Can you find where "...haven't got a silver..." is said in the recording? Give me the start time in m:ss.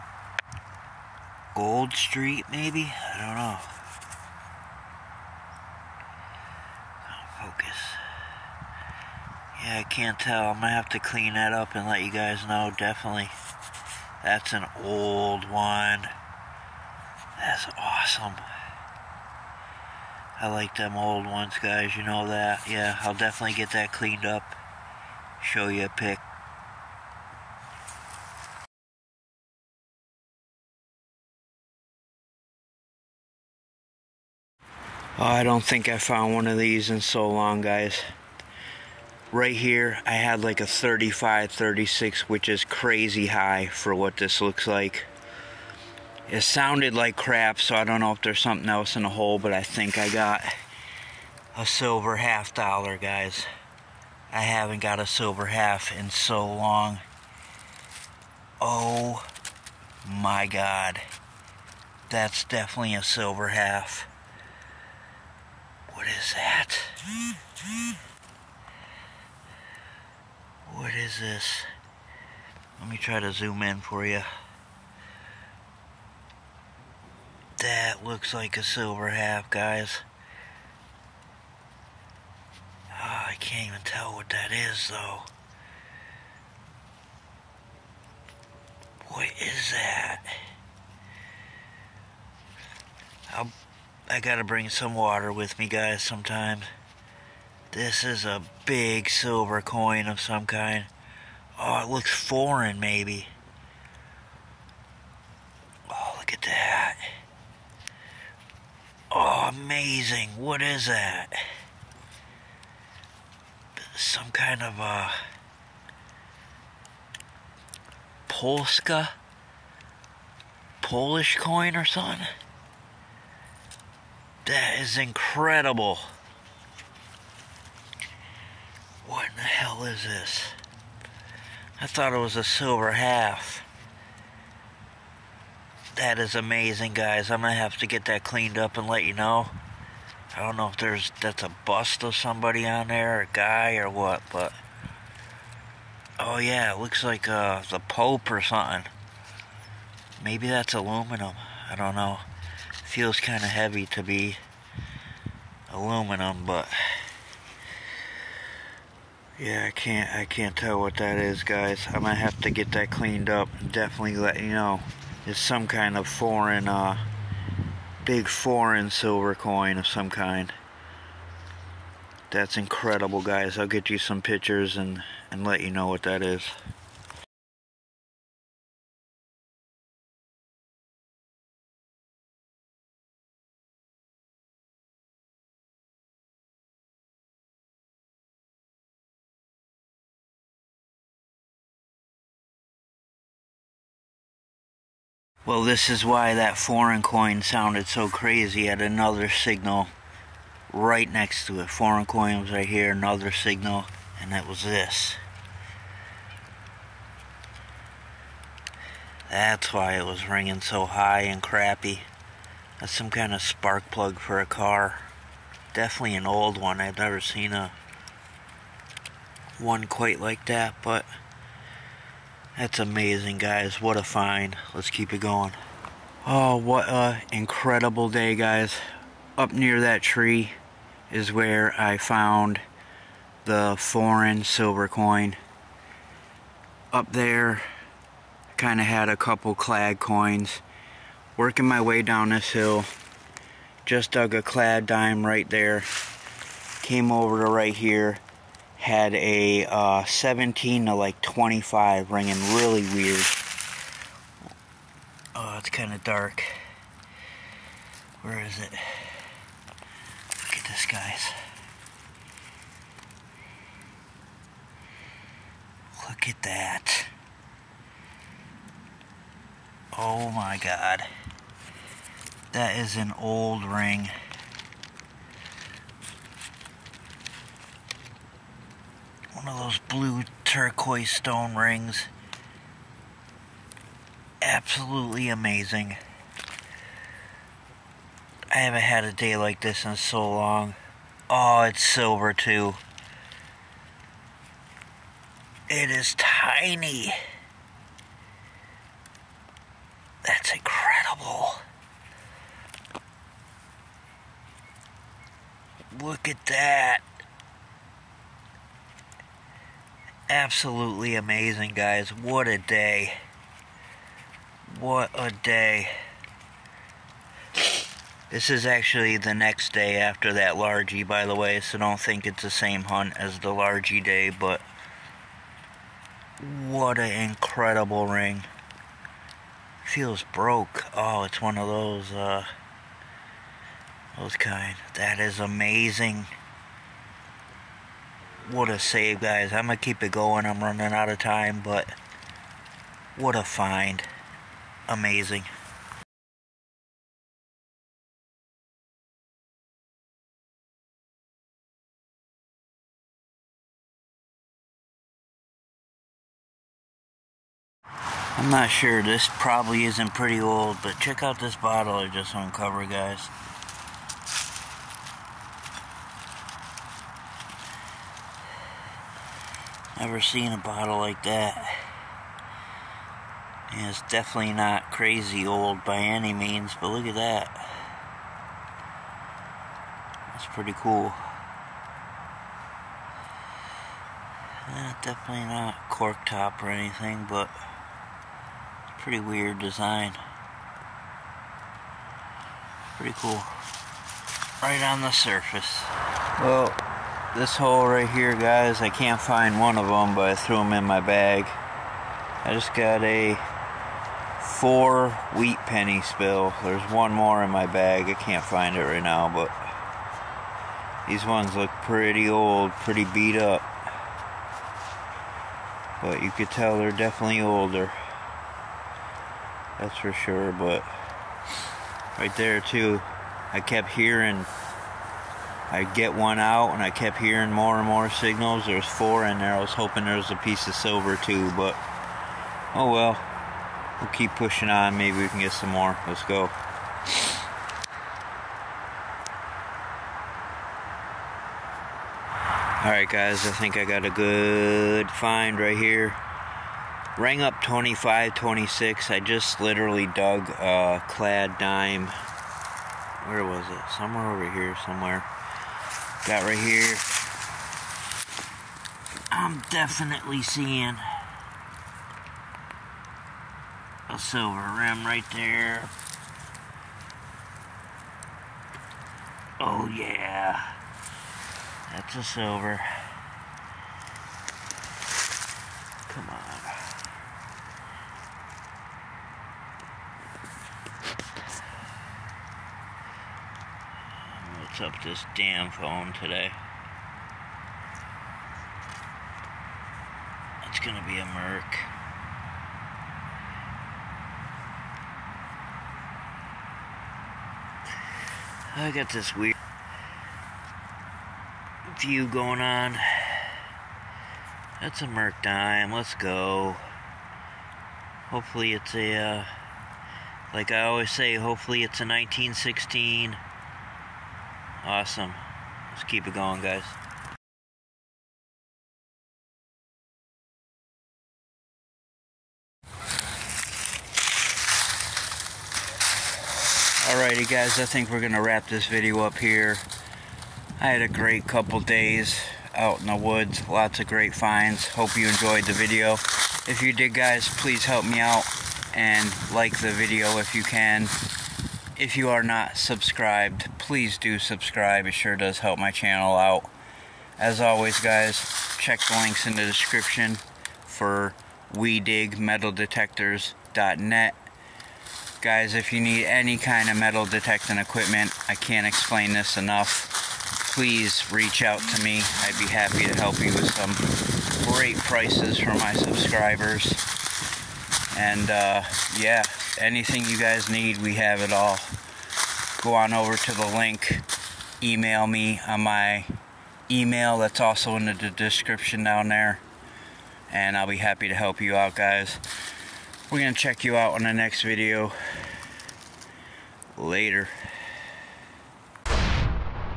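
0:54.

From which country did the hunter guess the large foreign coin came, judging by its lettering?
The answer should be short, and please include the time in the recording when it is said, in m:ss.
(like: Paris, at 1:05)
Polish, at 2:00.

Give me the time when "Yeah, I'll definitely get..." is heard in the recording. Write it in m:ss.
0:22.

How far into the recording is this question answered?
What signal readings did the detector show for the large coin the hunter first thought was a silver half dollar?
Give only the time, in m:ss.
0:40.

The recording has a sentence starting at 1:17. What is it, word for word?
that looks like a silver half, guys.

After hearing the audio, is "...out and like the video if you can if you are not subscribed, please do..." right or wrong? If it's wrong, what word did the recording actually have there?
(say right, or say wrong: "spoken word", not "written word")
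right.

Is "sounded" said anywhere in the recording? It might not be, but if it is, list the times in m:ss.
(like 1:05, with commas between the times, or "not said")
0:46, 3:17.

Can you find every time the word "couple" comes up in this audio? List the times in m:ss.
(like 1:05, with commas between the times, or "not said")
3:59, 8:51.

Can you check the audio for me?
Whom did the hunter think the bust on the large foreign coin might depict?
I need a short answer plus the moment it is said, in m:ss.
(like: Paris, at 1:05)
The Pope, at 2:27.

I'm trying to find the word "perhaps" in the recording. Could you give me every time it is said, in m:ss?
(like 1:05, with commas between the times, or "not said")
not said.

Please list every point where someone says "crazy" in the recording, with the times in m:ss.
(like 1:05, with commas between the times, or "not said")
0:42, 3:18, 6:14.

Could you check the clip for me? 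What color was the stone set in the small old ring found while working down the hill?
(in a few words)
Blue turquoise.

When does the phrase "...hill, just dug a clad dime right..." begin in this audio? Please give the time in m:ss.
4:02.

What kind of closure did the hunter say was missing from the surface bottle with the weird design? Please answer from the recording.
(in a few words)
Cork top.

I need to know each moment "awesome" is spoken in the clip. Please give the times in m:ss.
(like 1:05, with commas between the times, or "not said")
0:17, 8:34.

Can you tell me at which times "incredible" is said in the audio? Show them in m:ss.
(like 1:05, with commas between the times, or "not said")
2:04, 2:52, 3:47, 5:00, 5:27.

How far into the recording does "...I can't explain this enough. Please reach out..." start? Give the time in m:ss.
9:18.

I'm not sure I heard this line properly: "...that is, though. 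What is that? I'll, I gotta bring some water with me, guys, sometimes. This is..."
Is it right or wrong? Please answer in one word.
right.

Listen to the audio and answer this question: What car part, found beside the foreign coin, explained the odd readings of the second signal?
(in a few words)
Spark plug.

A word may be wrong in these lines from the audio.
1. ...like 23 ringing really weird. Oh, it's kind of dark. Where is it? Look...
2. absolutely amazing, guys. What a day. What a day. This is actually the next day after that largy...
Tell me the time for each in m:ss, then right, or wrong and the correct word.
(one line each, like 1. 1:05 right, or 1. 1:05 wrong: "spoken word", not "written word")
1. 4:10 wrong: "25", not "23"
2. 5:10 right.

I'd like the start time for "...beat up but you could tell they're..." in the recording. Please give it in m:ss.
6:53.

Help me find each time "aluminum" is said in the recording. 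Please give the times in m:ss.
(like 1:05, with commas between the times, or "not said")
2:30, 2:35.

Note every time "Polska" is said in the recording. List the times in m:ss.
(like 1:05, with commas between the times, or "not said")
1:58.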